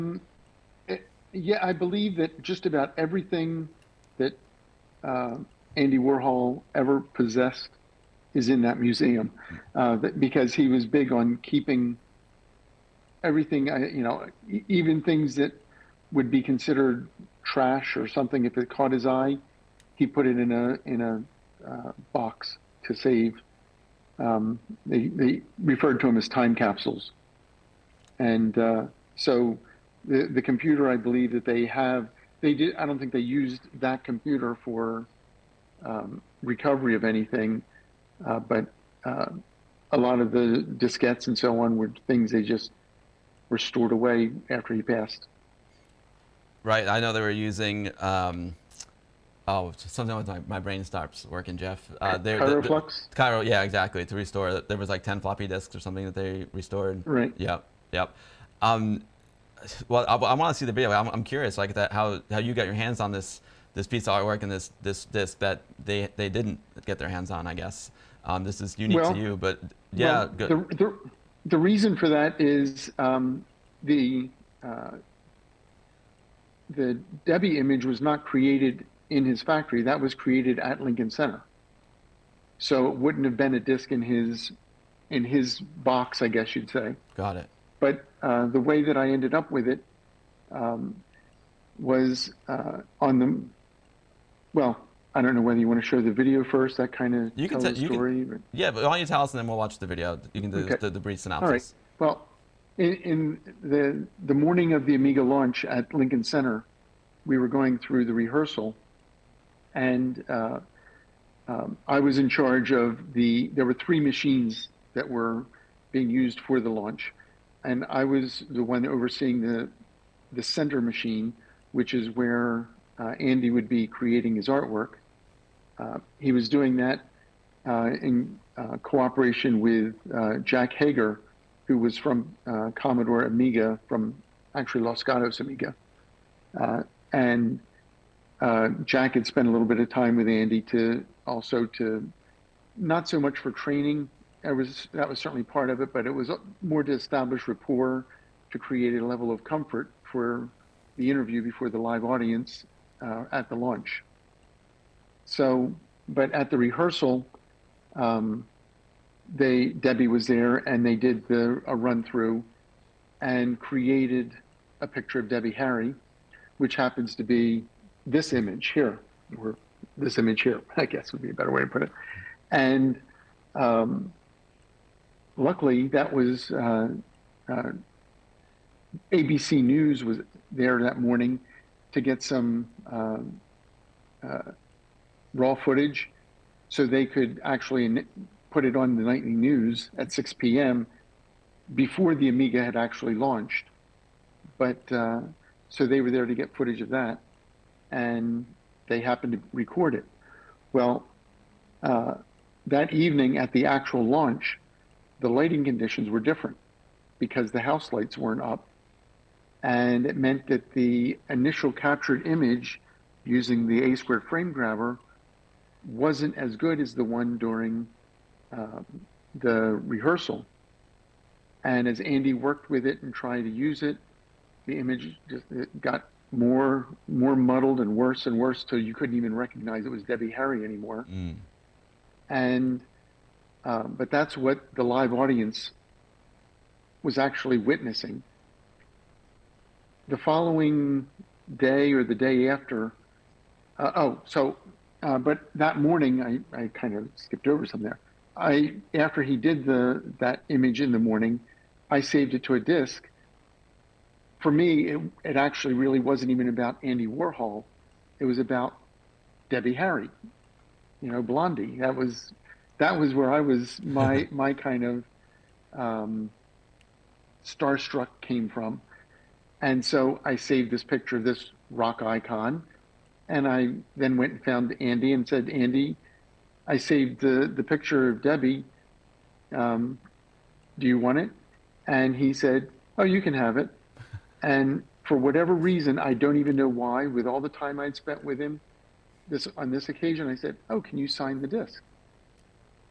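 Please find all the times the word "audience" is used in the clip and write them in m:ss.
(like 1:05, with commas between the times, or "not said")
2:32, 3:55.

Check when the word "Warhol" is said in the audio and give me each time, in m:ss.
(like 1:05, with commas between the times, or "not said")
0:05, 4:17.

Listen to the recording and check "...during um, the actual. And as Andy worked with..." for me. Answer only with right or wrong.
wrong.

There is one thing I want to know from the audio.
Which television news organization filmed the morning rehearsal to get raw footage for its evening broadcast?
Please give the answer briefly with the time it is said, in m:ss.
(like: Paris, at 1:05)
ABC News, at 2:59.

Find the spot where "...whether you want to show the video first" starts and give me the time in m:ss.
1:35.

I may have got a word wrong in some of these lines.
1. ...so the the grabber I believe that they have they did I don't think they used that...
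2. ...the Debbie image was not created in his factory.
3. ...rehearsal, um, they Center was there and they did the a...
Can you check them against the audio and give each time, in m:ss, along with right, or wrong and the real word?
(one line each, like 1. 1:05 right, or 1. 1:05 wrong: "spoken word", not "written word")
1. 0:29 wrong: "computer", not "grabber"
2. 1:16 right
3. 2:36 wrong: "Debbie", not "Center".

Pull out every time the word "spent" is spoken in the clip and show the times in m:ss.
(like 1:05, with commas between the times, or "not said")
2:19, 4:47.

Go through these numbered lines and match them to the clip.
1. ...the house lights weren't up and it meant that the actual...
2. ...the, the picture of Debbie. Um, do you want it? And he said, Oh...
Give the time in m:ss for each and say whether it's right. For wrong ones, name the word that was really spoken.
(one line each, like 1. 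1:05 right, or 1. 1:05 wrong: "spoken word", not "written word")
1. 3:27 wrong: "initial", not "actual"
2. 4:37 right.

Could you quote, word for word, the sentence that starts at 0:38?
Uh, but uh, a lot of the diskettes and so on were things they just were stored away after he passed.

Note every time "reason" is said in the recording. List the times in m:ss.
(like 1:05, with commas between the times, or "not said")
1:11, 4:45.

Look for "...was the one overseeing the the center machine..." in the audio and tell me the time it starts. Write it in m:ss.
1:58.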